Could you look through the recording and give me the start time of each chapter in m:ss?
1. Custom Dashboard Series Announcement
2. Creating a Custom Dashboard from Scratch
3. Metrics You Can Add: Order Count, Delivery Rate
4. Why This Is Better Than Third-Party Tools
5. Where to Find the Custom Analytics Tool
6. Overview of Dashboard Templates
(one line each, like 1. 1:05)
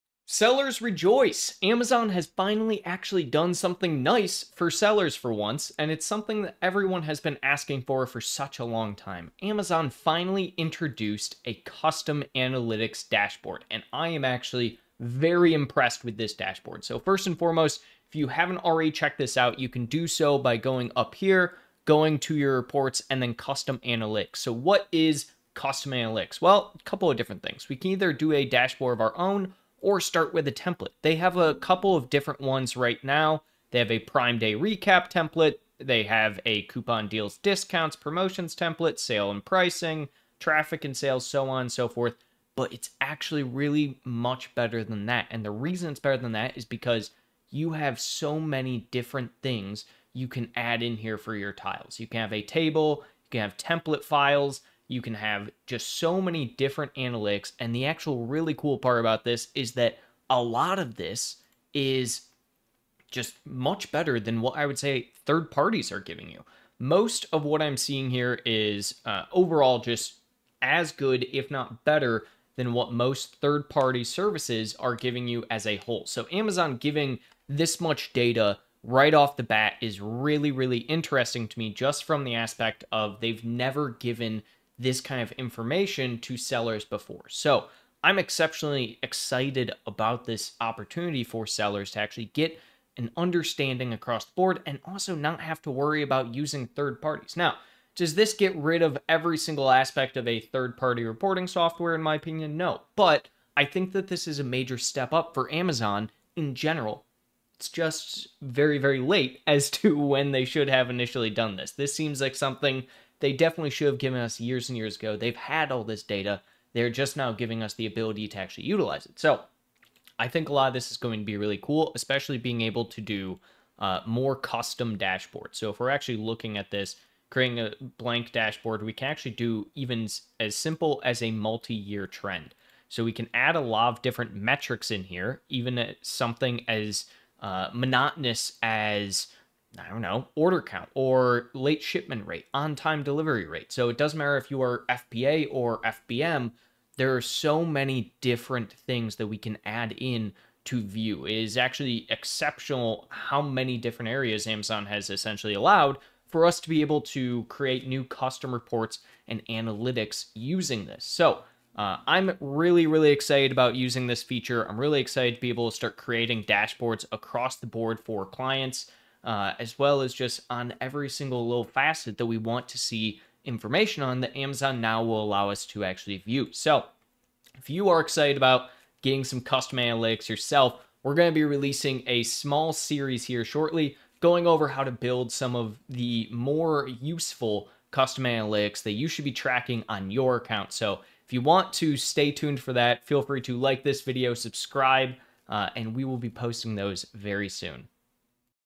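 1. 3:01
2. 2:00
3. 2:44
4. 1:16
5. 0:24
6. 0:40.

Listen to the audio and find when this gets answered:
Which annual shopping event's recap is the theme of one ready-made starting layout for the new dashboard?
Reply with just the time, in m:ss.
0:33.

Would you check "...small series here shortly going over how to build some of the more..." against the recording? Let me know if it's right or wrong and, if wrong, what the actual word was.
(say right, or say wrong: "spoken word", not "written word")
right.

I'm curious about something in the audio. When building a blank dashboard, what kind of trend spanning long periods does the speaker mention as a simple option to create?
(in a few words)
Multi-year trend.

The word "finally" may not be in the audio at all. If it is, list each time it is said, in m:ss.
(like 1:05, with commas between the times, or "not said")
0:02, 0:09.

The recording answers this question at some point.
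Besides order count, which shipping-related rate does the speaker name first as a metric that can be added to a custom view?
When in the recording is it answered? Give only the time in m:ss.
2:21.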